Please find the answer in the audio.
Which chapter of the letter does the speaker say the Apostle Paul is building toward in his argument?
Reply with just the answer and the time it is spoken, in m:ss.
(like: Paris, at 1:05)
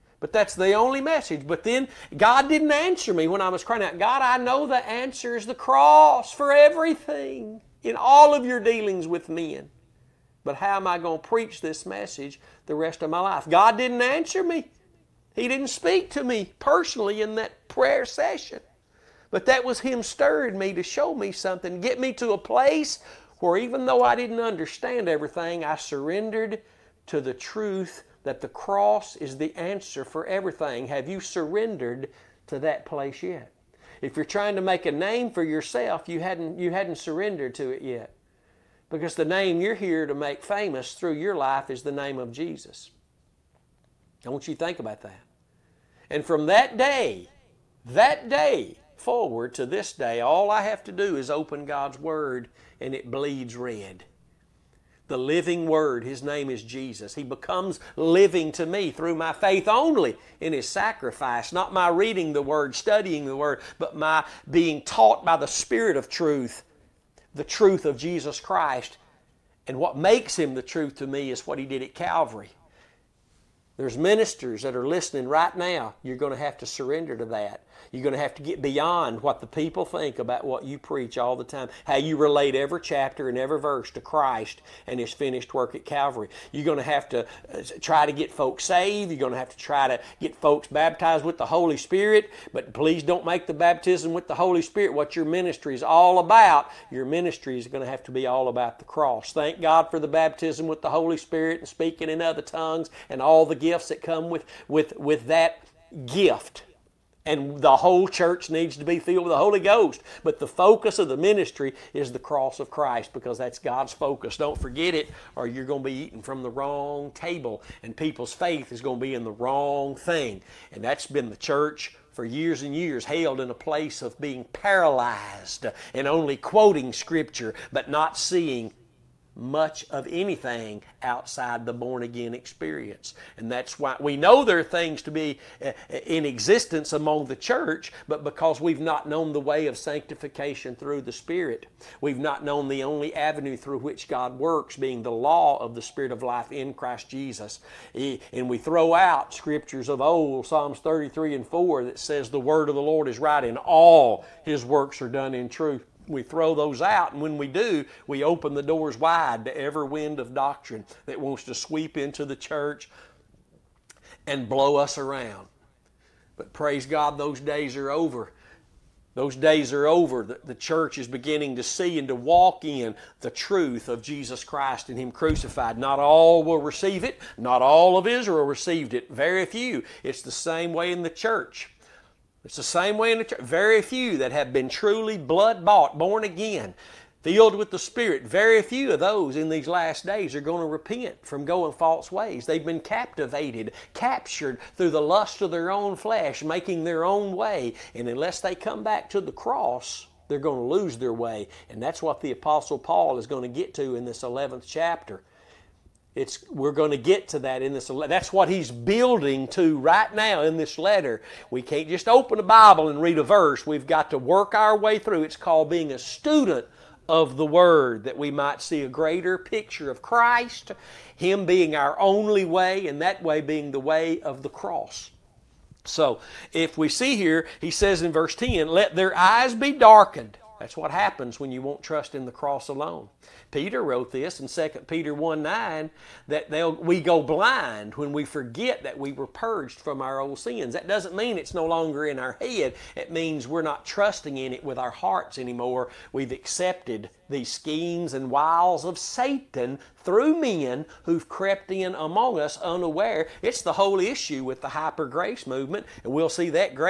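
11th chapter, at 3:24.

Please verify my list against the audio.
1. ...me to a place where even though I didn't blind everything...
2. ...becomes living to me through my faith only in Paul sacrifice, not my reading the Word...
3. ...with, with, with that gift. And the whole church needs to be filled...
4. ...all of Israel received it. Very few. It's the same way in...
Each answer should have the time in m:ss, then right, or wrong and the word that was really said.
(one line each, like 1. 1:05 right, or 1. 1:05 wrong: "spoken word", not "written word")
1. 0:21 wrong: "understand", not "blind"
2. 0:57 wrong: "His", not "Paul"
3. 1:44 right
4. 2:57 right.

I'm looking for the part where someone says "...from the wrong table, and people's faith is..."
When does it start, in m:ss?
1:56.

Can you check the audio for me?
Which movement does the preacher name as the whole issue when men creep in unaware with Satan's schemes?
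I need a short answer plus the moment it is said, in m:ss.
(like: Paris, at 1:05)
hyper grace movement, at 4:14.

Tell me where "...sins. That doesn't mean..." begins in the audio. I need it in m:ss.
4:00.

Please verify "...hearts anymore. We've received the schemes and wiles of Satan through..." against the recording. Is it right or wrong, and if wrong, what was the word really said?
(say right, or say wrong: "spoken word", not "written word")
wrong: "accepted", not "received".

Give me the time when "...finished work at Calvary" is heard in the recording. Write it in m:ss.
1:25.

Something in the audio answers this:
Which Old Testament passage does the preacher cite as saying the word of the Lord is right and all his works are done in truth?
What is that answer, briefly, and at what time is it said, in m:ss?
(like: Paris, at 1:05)
Psalms 33:4, at 2:30.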